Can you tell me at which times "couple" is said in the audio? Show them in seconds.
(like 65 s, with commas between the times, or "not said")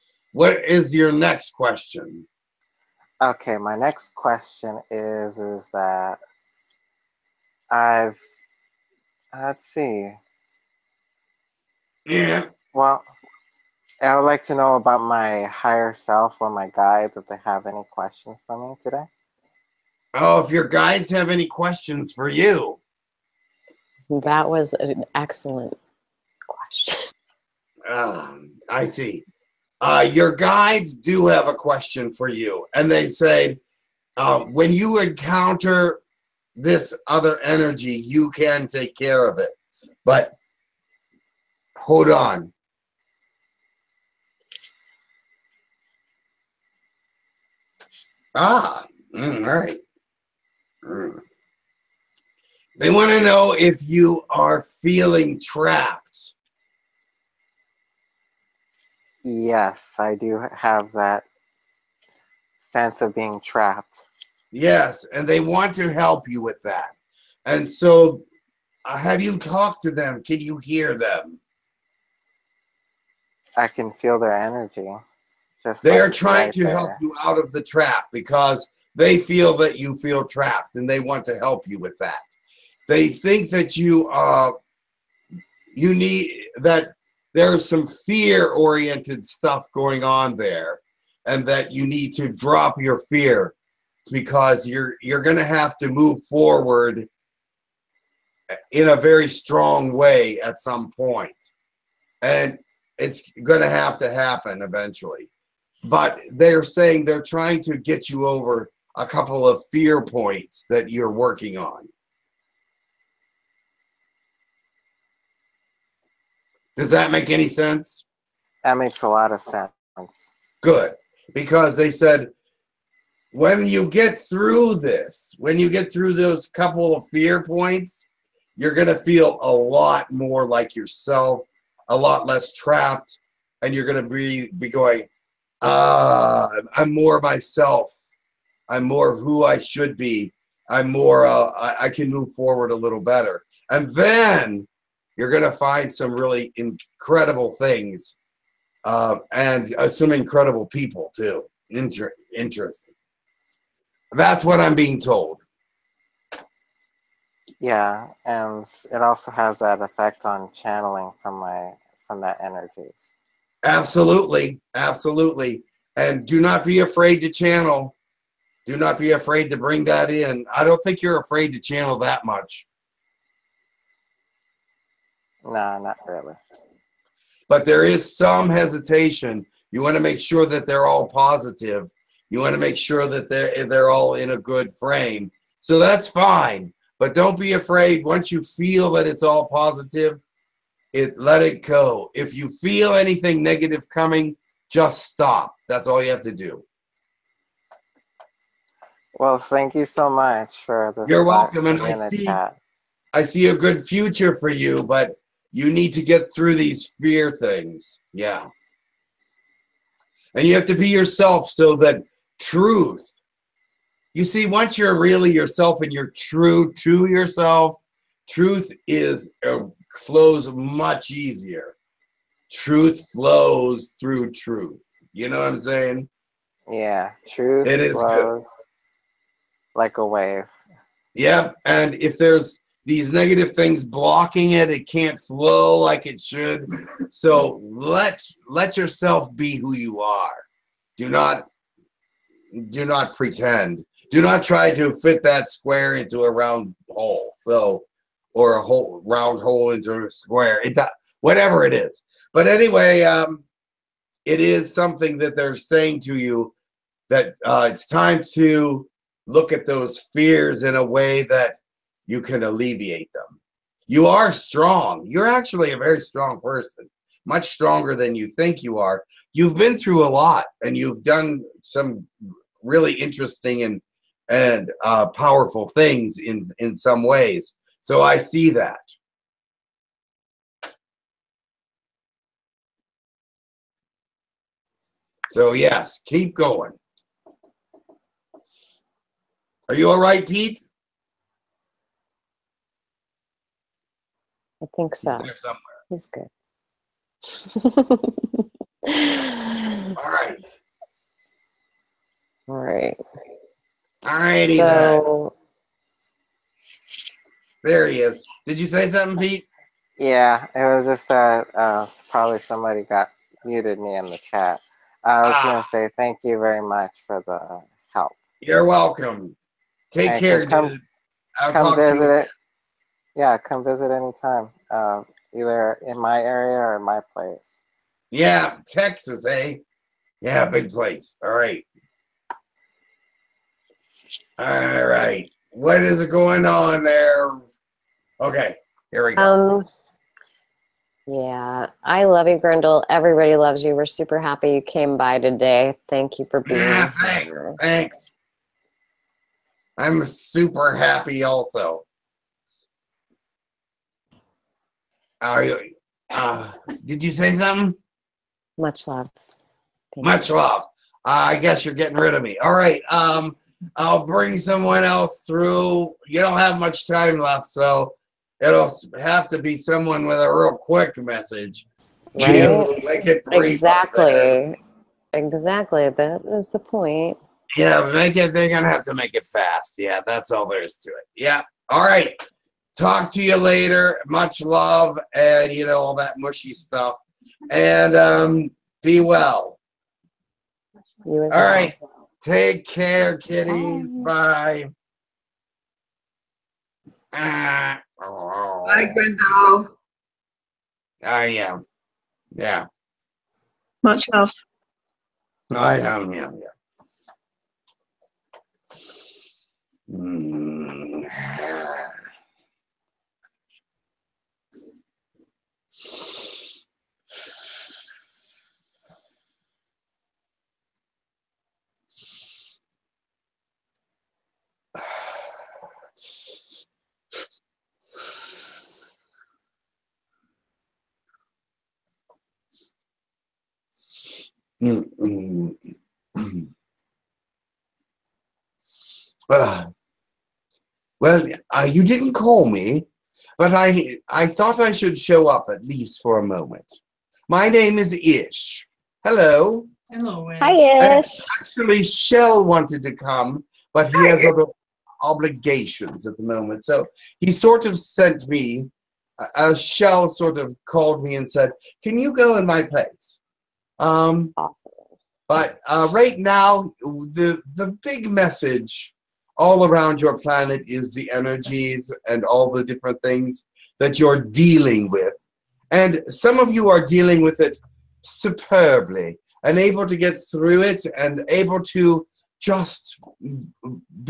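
109 s, 126 s.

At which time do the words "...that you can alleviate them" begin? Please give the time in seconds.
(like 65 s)
261 s.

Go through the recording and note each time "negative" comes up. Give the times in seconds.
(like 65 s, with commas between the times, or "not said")
193 s, 233 s.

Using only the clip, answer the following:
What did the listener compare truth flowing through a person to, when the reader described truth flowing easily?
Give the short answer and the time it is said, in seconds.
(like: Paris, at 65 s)
a wave, at 229 s.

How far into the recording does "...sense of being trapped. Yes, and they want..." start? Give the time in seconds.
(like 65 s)
62 s.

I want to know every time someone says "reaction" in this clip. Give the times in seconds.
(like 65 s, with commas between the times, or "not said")
not said.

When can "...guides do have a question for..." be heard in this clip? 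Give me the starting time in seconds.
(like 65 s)
30 s.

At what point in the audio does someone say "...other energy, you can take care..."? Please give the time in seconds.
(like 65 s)
37 s.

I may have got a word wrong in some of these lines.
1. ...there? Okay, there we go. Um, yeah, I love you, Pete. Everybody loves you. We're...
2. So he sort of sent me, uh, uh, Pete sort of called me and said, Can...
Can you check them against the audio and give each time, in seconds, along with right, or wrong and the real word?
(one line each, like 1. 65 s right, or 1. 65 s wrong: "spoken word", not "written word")
1. 336 s wrong: "Grindal", not "Pete"
2. 456 s wrong: "Shell", not "Pete".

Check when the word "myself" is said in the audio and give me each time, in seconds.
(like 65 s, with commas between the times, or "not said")
137 s.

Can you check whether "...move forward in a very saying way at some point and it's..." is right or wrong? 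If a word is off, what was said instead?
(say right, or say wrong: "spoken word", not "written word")
wrong: "strong", not "saying".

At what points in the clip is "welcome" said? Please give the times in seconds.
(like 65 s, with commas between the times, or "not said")
201 s, 318 s.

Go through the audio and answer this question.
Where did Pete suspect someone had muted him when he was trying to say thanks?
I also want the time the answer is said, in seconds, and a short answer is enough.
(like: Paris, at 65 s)
the chat, at 314 s.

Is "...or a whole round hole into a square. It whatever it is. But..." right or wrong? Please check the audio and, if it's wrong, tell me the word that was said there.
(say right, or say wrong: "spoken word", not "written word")
right.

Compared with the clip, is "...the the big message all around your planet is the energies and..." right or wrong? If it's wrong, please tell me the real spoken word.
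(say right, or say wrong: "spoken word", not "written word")
right.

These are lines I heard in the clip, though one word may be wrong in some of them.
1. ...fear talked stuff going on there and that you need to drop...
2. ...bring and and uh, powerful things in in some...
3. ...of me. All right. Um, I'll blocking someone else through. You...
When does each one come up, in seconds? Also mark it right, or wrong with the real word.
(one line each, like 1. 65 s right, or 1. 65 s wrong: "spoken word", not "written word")
1. 88 s wrong: "oriented", not "talked"
2. 272 s wrong: "interesting", not "bring"
3. 362 s wrong: "bring", not "blocking".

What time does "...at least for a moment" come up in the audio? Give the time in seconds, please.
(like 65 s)
445 s.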